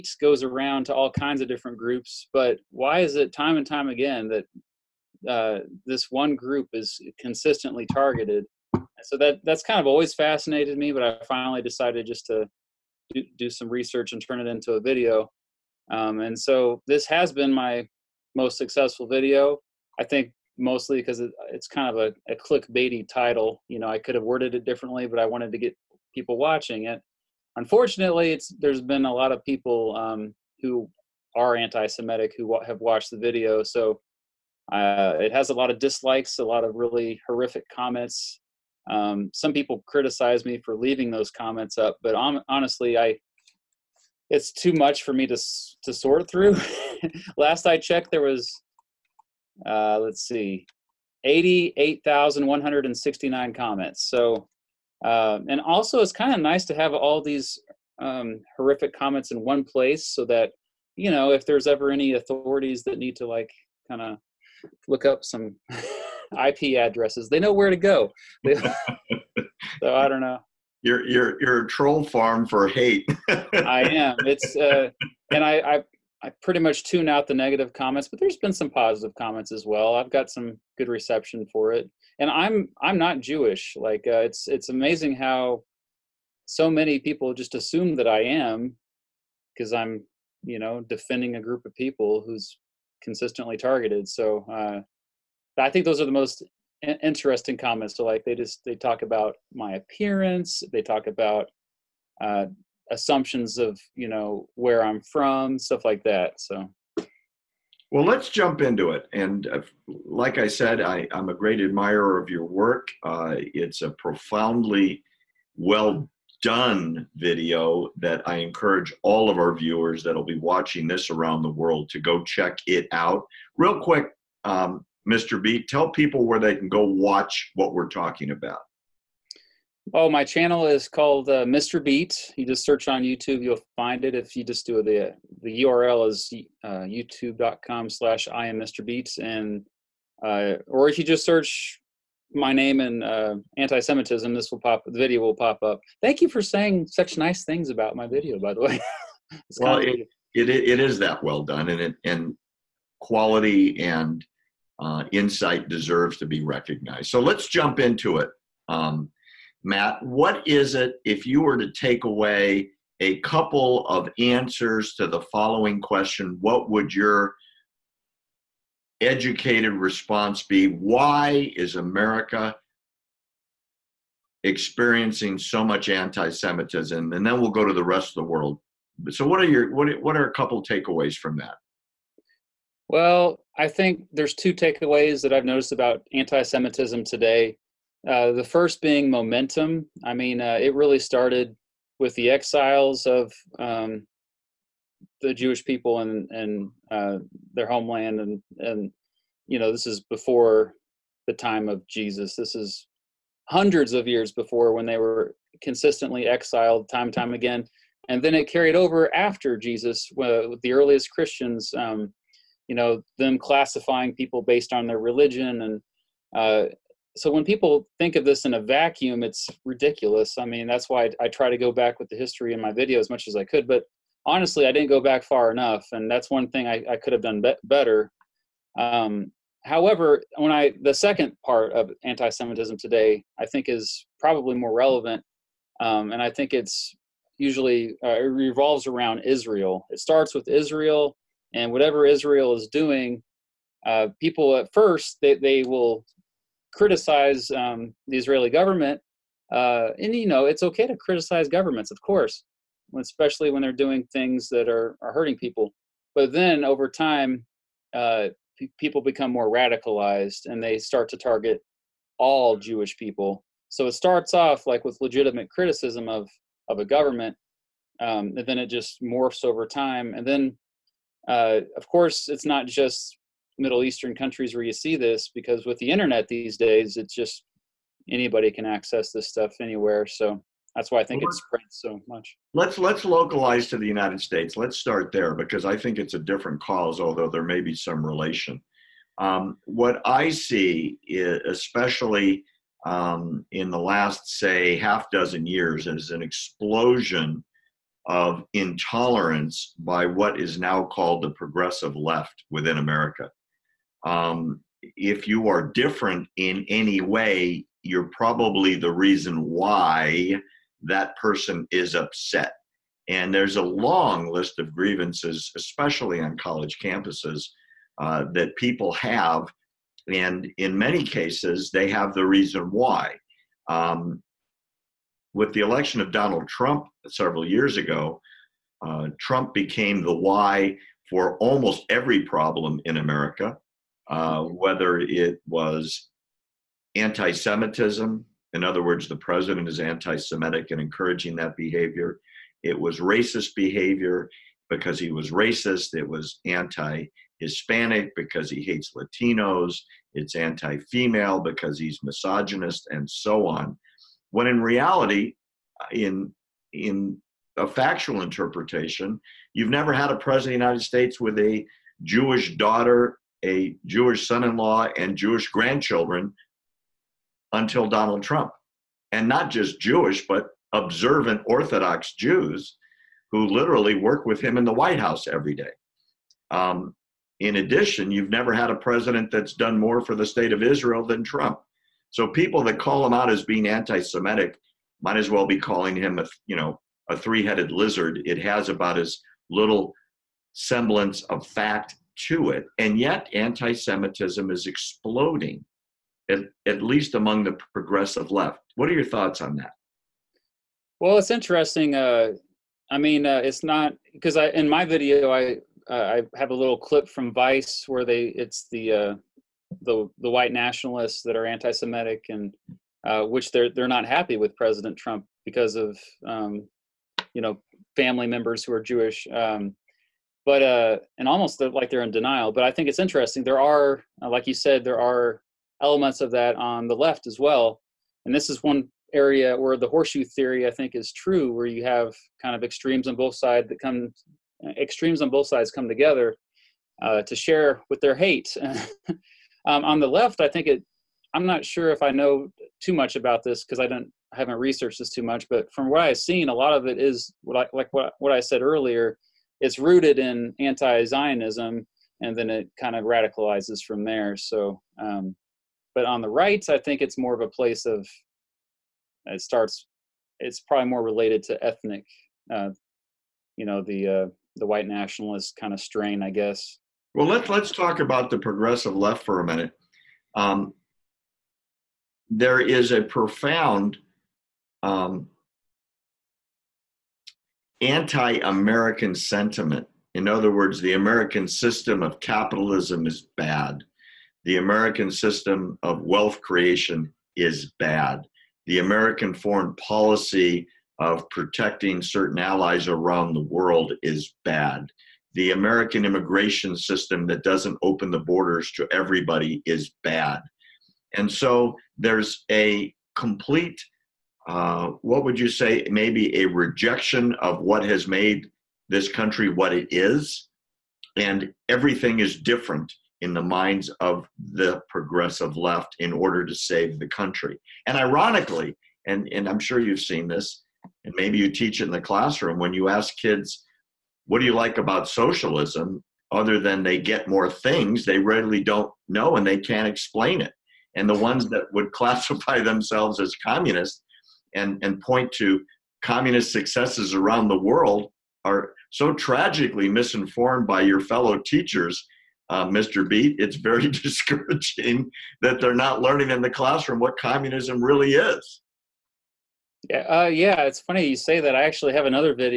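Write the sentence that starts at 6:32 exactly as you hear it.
And yet, anti Semitism is exploding, at, at least among the progressive left.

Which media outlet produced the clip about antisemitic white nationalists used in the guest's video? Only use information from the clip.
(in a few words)
Vice.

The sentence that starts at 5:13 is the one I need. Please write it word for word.
And there's a long list of grievances, especially on college campuses, uh, that people have.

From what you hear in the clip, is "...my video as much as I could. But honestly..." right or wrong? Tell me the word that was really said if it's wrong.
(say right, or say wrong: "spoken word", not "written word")
right.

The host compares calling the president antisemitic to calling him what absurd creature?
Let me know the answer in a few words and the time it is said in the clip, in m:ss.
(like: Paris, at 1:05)
a three-headed lizard, at 6:27.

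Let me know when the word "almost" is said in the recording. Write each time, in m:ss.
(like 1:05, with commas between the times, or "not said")
5:31, 7:01.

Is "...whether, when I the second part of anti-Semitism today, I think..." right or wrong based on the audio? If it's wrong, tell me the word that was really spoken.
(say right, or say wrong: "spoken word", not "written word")
wrong: "however", not "whether".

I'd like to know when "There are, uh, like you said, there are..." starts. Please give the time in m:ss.
7:03.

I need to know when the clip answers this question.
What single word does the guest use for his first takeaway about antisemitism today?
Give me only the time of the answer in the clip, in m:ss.
3:09.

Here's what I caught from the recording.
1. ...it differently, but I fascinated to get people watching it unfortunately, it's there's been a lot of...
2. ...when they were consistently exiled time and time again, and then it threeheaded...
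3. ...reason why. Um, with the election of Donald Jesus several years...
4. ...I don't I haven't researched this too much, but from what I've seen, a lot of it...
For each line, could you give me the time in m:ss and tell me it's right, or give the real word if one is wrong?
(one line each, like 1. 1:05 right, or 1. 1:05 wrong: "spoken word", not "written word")
1. 0:24 wrong: "wanted", not "fascinated"
2. 3:24 wrong: "carried", not "threeheaded"
3. 5:22 wrong: "Trump", not "Jesus"
4. 7:23 right.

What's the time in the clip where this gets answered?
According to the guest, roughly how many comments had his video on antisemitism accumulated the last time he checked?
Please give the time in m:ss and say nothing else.
0:51.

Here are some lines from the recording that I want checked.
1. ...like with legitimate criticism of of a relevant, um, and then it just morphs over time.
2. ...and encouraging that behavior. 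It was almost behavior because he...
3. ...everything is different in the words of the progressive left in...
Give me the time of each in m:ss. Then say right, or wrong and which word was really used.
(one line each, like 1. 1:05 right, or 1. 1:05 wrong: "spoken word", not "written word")
1. 4:24 wrong: "government", not "relevant"
2. 5:40 wrong: "racist", not "almost"
3. 8:31 wrong: "minds", not "words".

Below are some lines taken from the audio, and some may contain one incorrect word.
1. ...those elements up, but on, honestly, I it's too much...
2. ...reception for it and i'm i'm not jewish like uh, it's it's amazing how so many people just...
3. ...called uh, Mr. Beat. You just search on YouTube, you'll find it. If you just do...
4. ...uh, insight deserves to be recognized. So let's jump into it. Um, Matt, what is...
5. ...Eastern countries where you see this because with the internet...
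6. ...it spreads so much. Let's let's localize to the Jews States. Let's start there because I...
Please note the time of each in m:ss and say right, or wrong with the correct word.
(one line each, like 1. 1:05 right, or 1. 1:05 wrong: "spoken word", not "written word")
1. 0:41 wrong: "comments", not "elements"
2. 1:20 right
3. 2:10 right
4. 2:34 right
5. 4:33 right
6. 4:41 wrong: "United", not "Jews".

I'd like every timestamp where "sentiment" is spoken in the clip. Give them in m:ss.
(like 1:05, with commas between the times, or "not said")
7:59.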